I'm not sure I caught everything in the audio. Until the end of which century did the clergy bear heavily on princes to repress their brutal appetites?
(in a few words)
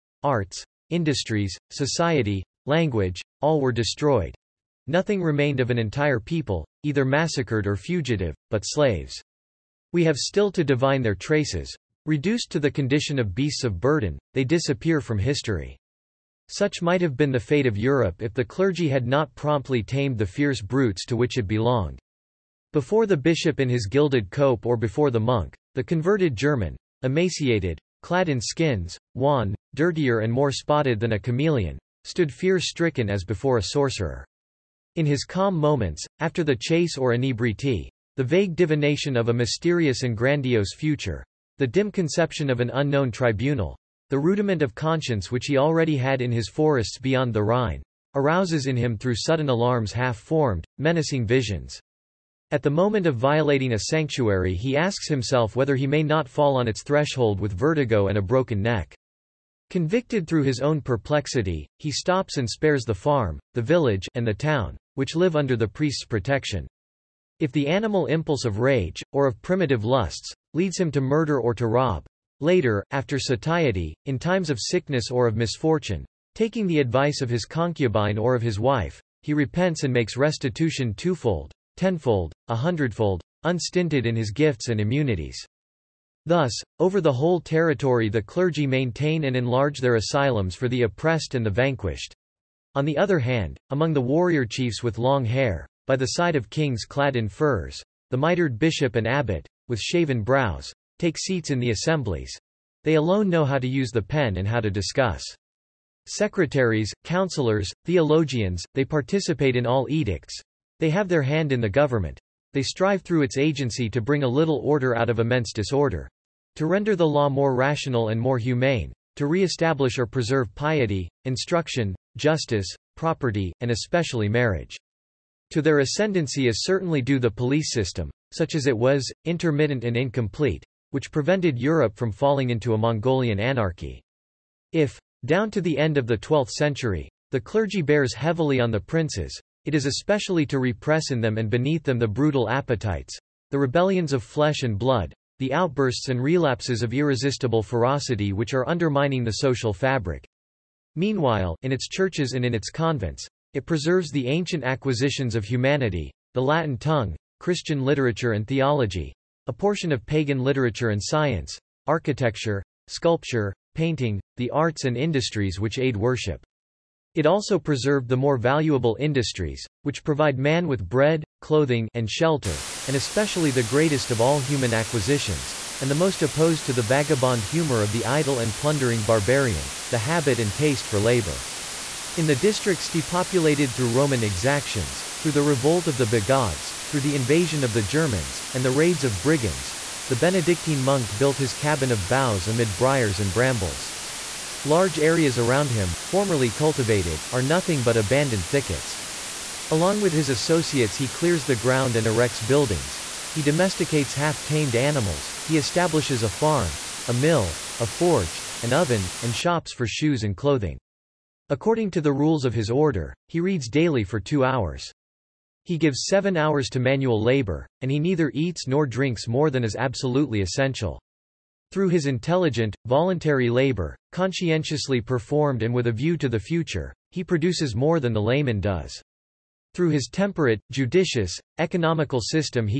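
12th century.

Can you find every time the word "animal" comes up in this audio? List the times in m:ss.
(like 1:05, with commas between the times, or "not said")
1:07, 3:24.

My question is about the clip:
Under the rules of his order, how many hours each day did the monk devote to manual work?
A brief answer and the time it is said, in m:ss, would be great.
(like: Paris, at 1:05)
7, at 3:36.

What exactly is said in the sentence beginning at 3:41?
Through his intelligent, voluntary labor, Conscientiously performed and with a view to the future, he produces more than the layman does.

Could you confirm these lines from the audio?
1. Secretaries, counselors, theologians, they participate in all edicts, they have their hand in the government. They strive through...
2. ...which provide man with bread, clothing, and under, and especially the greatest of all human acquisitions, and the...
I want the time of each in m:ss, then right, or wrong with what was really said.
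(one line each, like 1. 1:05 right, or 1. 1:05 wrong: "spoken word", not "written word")
1. 1:46 right
2. 2:49 wrong: "shelter", not "under".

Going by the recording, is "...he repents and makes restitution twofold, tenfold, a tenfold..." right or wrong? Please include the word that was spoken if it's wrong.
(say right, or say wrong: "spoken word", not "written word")
wrong: "hundredfold", not "tenfold".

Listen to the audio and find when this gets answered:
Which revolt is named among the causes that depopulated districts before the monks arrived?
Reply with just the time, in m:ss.
3:06.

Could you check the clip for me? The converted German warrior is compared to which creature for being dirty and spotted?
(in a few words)
Chameleon.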